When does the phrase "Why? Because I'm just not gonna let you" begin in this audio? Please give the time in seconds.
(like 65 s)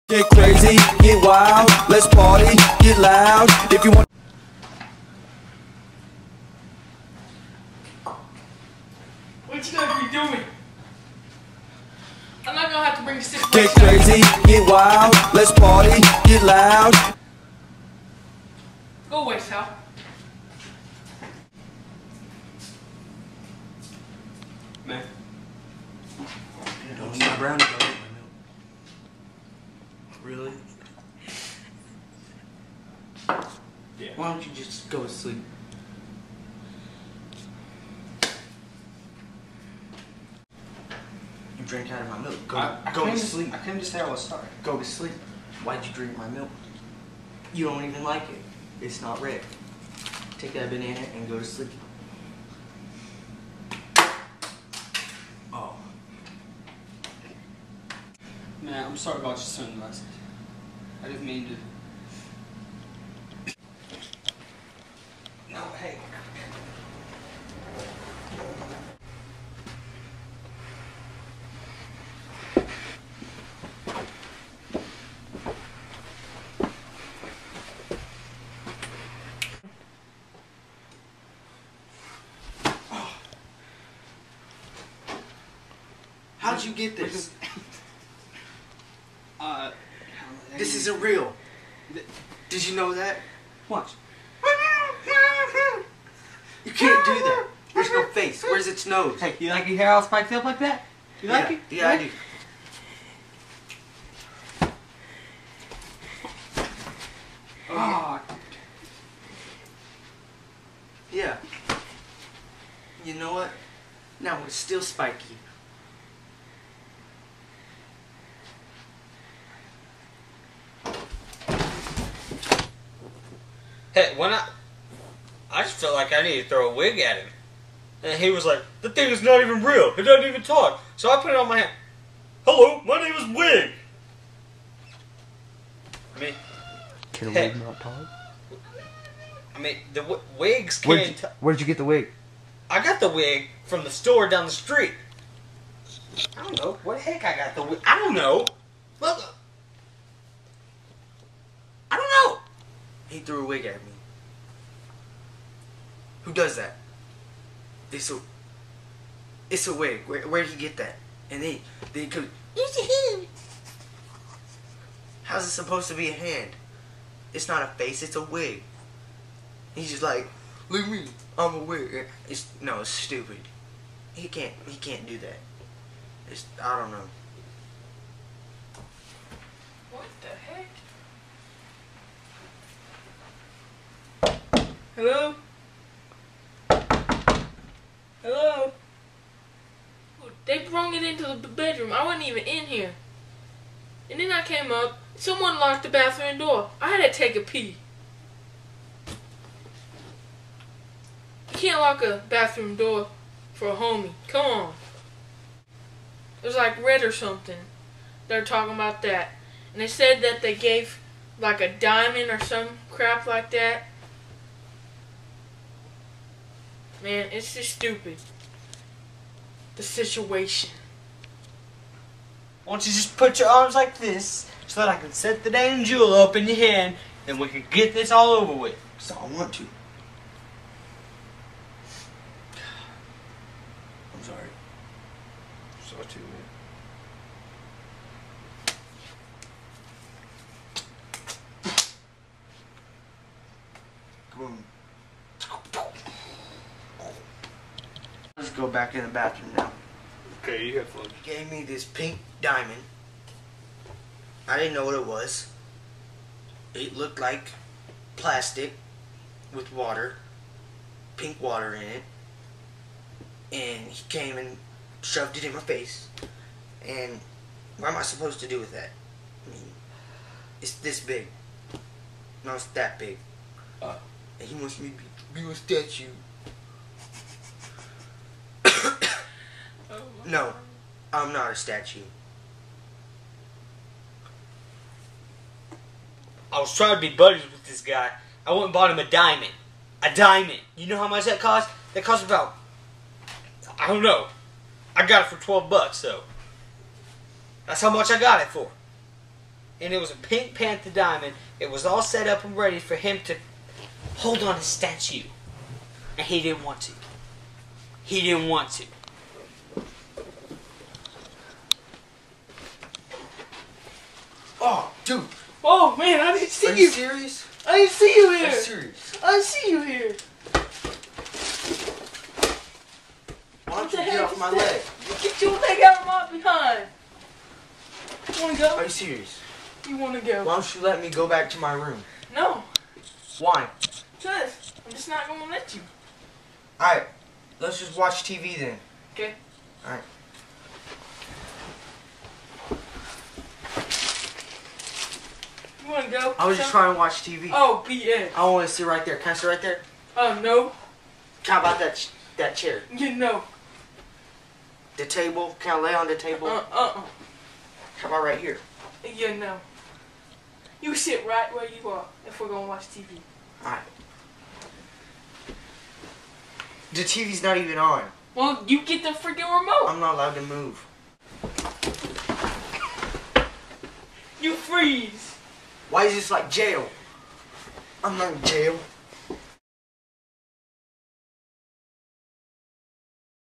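333 s.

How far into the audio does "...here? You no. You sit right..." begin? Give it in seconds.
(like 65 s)
358 s.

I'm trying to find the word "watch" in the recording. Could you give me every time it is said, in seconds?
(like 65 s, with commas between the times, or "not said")
93 s, 337 s, 346 s, 362 s.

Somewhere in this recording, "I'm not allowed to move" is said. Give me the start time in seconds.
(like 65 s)
369 s.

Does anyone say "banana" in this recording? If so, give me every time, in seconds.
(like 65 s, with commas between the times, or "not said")
50 s.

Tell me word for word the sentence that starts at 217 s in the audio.
Man, it's just stupid the situation.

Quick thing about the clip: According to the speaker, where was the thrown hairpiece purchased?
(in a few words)
the store down the street.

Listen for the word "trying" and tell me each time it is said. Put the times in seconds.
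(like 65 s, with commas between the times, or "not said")
286 s, 346 s.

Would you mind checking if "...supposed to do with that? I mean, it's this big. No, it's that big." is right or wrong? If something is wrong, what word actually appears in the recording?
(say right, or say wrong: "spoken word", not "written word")
right.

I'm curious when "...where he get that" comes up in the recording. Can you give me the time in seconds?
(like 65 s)
160 s.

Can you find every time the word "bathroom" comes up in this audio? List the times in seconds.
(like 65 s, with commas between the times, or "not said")
195 s, 202 s, 249 s.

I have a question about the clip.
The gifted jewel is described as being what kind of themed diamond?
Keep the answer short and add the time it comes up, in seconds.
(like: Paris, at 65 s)
pink panther diamond, at 300 s.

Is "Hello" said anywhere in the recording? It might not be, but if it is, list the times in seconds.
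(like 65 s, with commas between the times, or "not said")
132 s, 184 s.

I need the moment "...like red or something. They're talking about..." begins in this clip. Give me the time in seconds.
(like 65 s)
206 s.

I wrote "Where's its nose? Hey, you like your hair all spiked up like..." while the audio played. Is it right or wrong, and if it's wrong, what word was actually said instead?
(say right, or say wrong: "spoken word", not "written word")
right.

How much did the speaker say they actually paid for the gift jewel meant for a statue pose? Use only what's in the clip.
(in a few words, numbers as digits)
$12.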